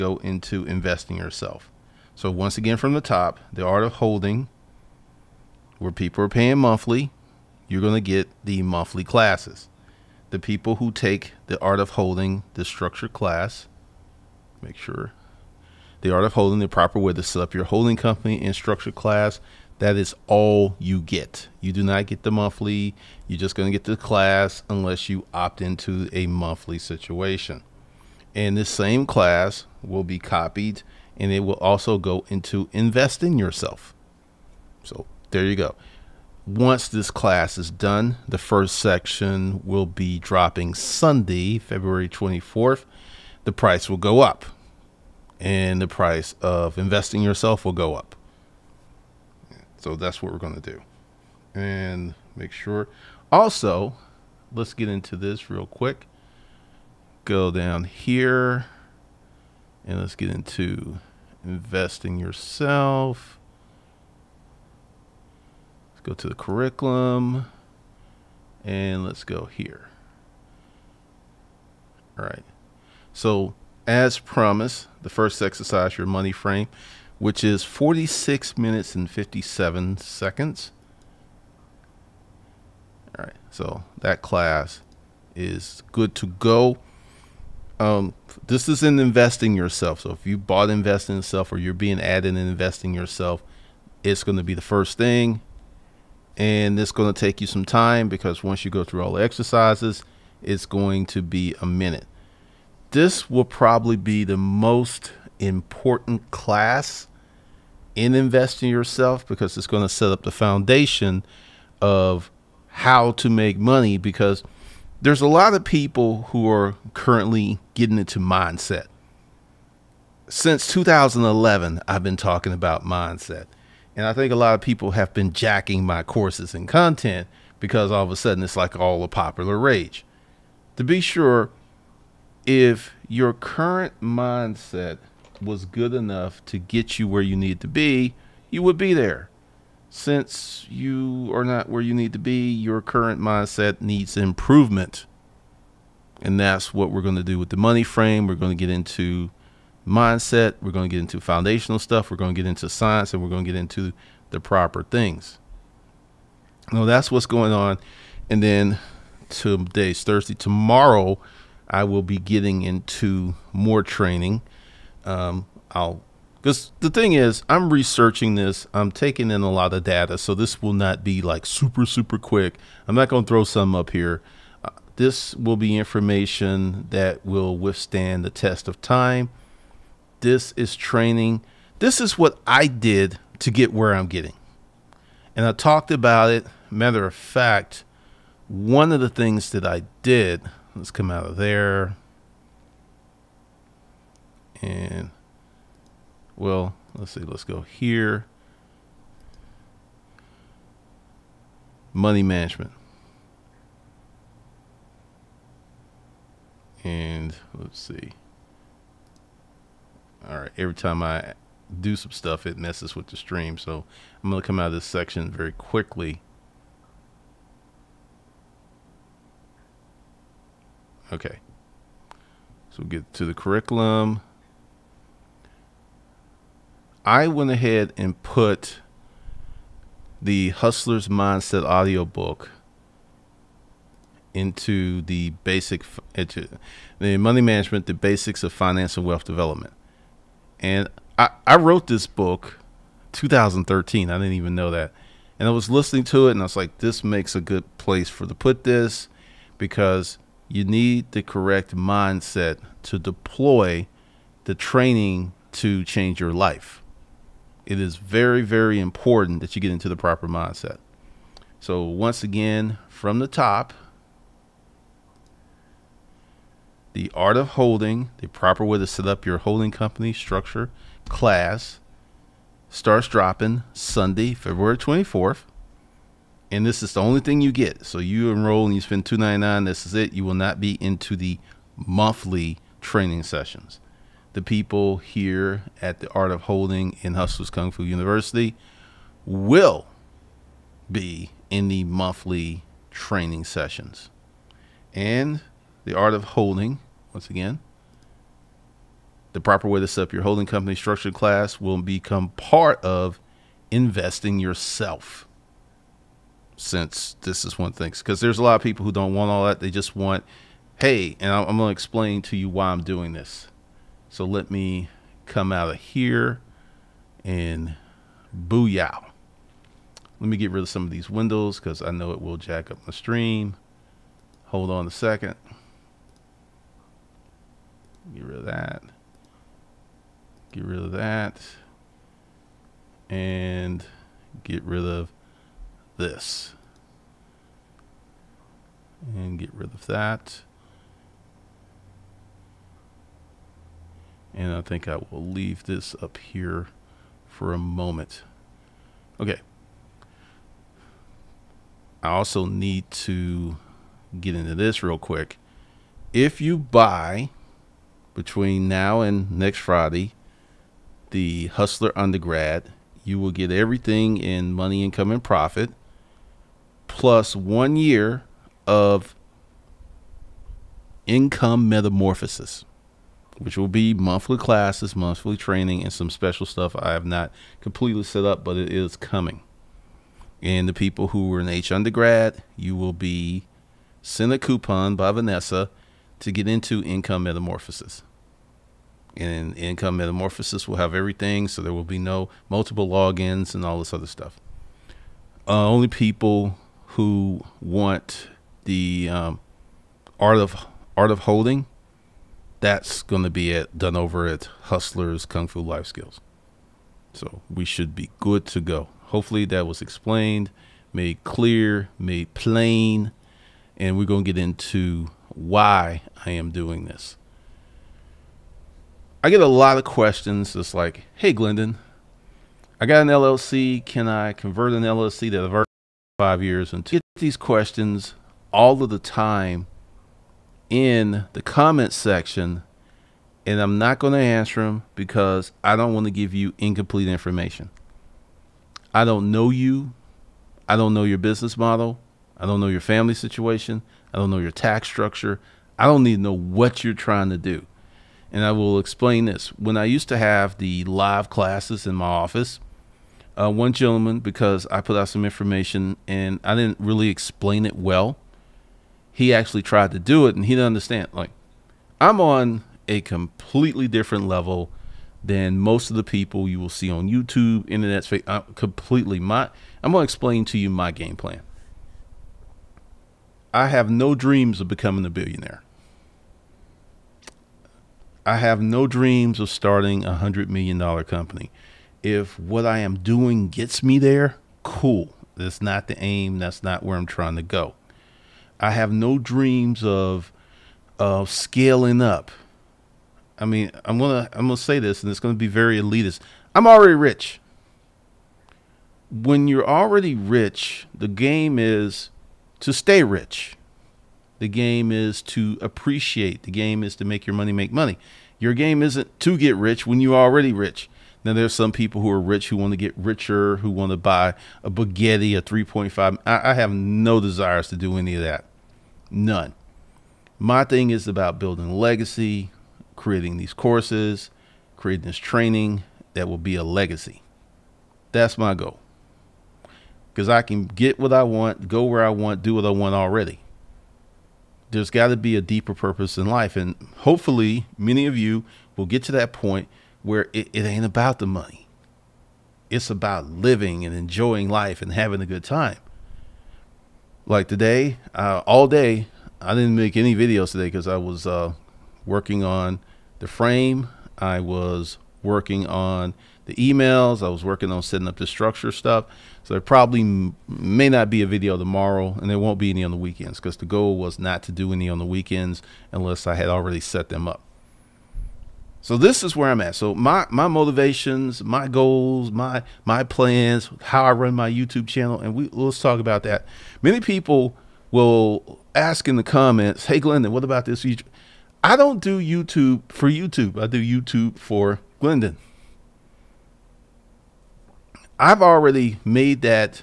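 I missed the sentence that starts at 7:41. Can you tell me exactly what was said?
Like, I'm on a completely different level than most of the people you will see on YouTube, internet space.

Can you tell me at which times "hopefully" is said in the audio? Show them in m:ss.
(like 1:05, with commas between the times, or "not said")
6:49, 8:56.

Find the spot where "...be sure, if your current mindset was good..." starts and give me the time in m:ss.
2:10.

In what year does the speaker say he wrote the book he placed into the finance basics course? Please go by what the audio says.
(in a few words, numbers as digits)
2013.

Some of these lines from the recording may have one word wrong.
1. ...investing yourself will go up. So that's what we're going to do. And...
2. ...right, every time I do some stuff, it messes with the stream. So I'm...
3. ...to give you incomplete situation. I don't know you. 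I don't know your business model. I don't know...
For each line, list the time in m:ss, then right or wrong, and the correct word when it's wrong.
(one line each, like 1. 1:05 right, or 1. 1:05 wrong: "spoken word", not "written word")
1. 0:46 right
2. 3:30 right
3. 7:16 wrong: "information", not "situation".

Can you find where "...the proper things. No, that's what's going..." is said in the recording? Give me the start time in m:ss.
2:34.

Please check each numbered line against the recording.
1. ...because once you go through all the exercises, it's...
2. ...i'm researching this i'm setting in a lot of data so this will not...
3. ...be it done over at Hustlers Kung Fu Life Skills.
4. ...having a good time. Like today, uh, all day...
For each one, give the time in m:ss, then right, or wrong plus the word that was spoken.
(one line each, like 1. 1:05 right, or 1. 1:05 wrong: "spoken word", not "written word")
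1. 1:38 right
2. 2:47 wrong: "taking", not "setting"
3. 6:43 right
4. 9:04 right.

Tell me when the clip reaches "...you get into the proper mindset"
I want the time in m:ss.
4:19.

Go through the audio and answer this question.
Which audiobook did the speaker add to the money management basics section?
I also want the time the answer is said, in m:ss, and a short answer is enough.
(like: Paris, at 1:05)
Hustler's Mindset, at 3:50.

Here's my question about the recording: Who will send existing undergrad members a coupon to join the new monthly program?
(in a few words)
Vanessa.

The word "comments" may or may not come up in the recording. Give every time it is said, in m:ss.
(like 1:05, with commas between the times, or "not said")
7:11, 9:39.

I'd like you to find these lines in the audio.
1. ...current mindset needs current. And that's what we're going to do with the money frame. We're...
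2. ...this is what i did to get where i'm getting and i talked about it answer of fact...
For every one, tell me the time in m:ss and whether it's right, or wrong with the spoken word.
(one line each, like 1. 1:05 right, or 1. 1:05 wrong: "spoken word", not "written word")
1. 2:22 wrong: "improvement", not "current"
2. 3:01 wrong: "matter", not "answer".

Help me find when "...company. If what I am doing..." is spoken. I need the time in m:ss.
8:01.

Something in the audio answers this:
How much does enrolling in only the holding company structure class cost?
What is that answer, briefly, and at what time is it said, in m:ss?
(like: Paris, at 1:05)
299, at 4:39.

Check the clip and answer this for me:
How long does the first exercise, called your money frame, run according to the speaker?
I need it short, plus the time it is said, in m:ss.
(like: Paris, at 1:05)
46 minutes and 57 seconds, at 1:17.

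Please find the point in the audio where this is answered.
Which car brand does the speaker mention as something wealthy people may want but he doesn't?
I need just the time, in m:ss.
8:34.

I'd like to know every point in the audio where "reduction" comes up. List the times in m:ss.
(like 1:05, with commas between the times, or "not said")
not said.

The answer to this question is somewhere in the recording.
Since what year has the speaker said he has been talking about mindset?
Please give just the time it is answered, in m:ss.
2:00.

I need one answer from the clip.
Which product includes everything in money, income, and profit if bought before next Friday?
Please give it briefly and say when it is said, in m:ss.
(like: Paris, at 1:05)
Hustler Undergrad, at 6:01.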